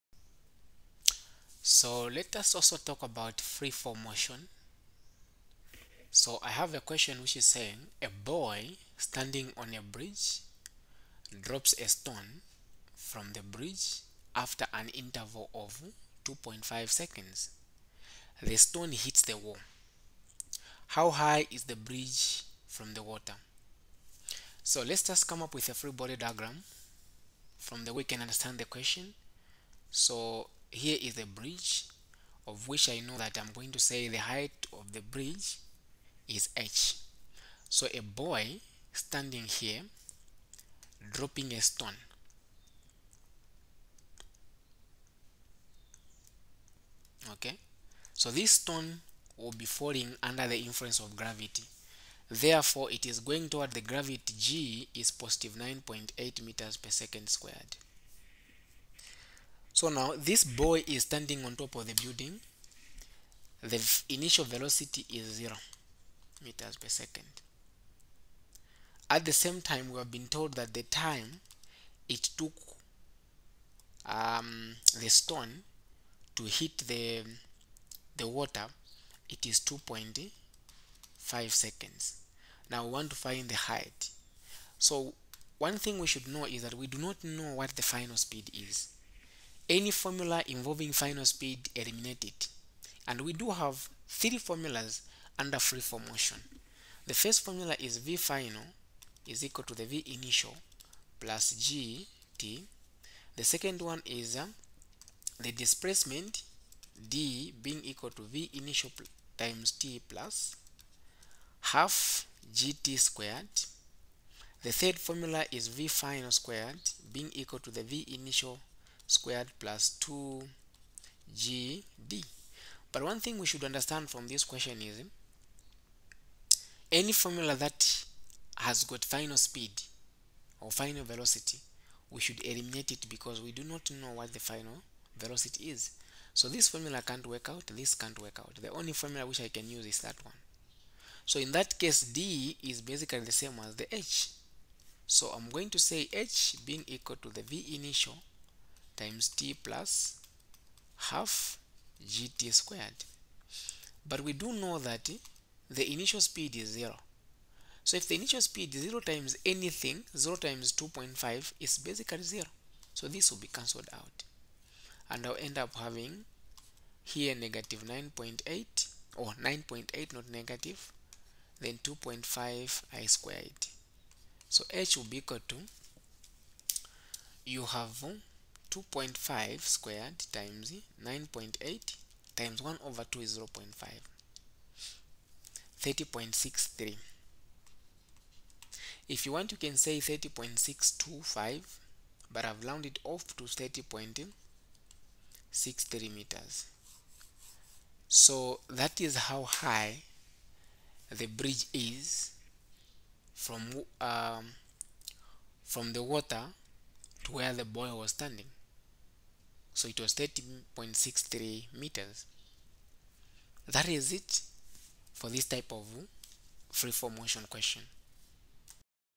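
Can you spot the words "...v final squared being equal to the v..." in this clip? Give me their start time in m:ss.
1:55.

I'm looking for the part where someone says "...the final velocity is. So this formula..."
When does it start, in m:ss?
2:14.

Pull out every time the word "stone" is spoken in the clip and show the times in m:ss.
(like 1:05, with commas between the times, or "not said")
0:11, 0:18, 0:41, 0:48, 1:15.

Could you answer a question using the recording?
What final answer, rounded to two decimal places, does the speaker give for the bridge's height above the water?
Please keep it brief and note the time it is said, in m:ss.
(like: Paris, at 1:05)
30.63 meters, at 3:13.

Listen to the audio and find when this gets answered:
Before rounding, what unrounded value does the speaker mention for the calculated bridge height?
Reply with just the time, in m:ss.
3:09.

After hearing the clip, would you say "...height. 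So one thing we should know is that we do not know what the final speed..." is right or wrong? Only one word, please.
right.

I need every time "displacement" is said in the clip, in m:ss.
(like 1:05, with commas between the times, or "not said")
1:45.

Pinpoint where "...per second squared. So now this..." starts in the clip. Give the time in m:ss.
0:56.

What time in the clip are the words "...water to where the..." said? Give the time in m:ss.
3:26.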